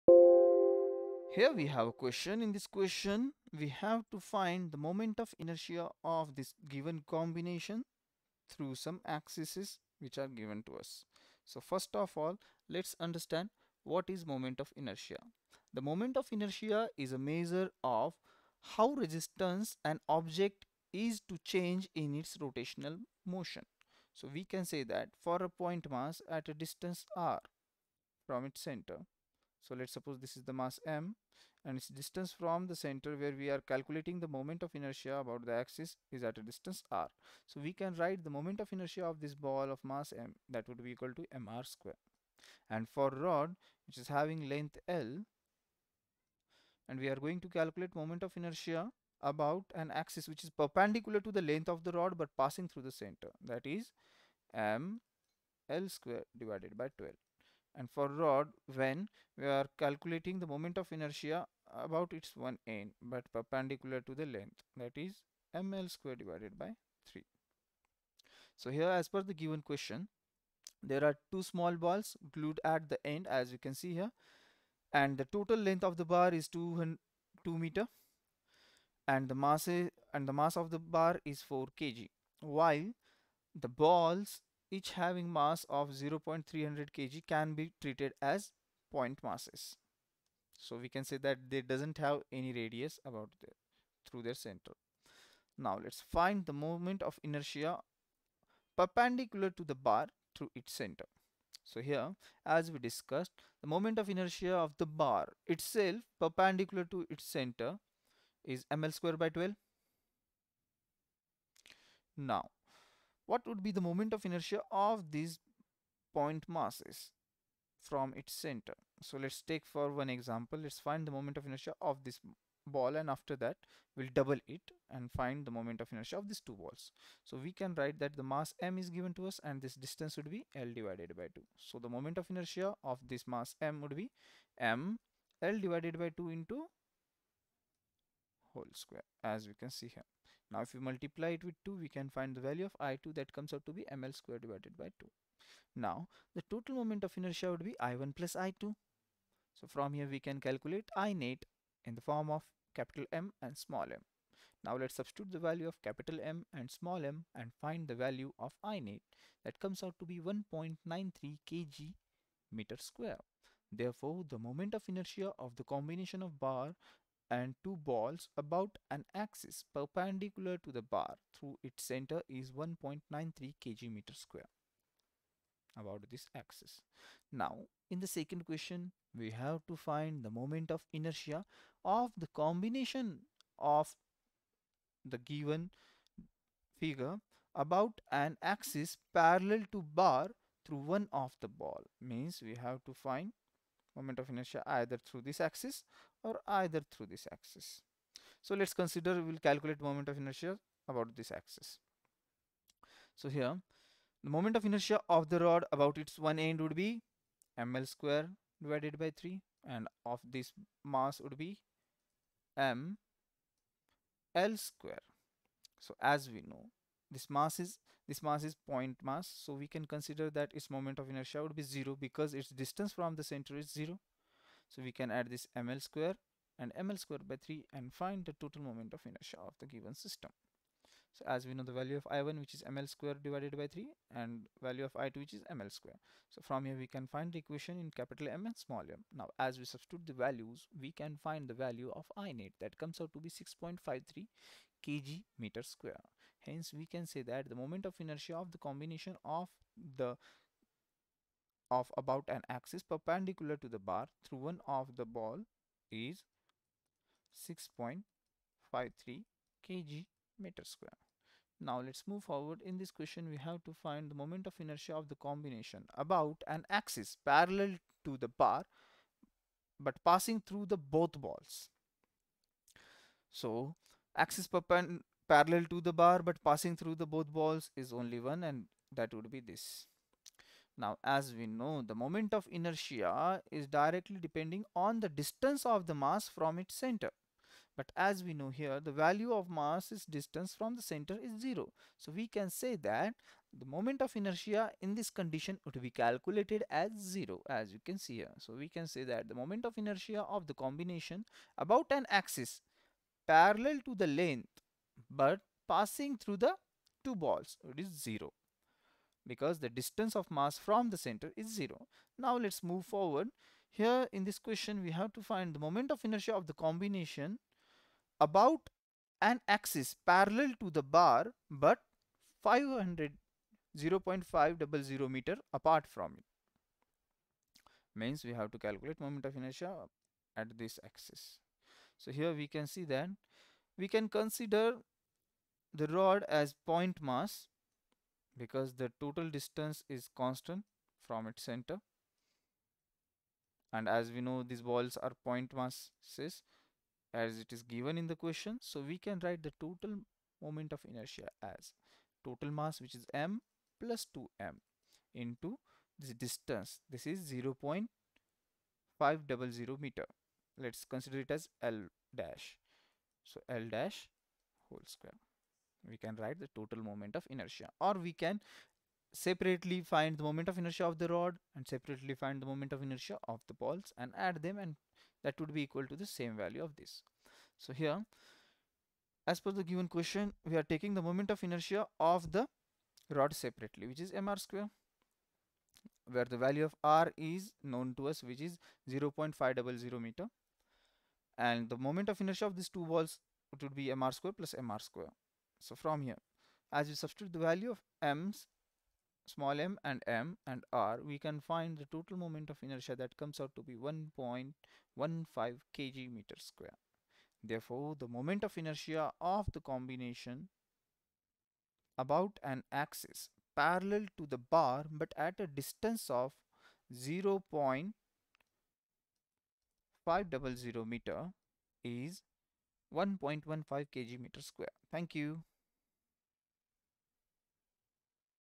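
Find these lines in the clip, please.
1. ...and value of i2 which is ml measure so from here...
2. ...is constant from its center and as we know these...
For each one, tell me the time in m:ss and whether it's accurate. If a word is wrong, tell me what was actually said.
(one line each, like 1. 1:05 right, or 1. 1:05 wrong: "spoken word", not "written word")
1. 3:54 wrong: "square", not "measure"
2. 5:39 right.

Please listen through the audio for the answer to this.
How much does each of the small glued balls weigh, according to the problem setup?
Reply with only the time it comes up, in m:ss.
1:25.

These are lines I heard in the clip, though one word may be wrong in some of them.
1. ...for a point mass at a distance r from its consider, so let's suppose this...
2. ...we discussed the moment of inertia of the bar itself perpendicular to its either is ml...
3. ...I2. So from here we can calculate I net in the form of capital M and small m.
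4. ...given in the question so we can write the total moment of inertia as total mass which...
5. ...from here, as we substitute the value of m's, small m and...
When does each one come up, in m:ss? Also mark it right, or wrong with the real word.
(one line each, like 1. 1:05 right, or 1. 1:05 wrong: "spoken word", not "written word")
1. 0:25 wrong: "center", not "consider"
2. 1:42 wrong: "center", not "either"
3. 2:28 right
4. 5:47 right
5. 6:35 right.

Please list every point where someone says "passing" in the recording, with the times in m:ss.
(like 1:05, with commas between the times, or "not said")
0:52, 4:30, 4:36, 5:05.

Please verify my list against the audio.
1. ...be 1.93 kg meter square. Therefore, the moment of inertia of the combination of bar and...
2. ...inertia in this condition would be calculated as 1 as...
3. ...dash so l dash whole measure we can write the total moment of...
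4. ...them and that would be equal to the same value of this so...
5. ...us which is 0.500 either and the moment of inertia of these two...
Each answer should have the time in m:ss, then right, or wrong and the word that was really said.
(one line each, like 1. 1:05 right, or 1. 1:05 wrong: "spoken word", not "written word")
1. 2:40 right
2. 4:54 wrong: "0", not "1"
3. 6:02 wrong: "square", not "measure"
4. 6:14 right
5. 6:28 wrong: "meter", not "either".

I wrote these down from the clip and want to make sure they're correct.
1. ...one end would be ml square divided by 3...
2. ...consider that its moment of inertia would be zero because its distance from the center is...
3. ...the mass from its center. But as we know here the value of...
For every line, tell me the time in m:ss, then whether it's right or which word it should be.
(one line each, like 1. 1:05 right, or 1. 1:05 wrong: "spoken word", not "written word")
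1. 3:26 right
2. 3:39 right
3. 4:45 right.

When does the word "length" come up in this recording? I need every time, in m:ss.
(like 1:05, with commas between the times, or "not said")
0:44, 0:51, 1:04, 1:15.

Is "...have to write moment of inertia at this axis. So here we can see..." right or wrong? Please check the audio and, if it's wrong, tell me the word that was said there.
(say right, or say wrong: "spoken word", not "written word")
wrong: "calculate", not "write".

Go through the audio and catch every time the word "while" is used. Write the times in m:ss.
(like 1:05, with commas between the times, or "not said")
1:22.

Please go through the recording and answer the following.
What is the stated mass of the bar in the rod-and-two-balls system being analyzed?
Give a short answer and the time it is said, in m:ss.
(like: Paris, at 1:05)
4 kg, at 1:21.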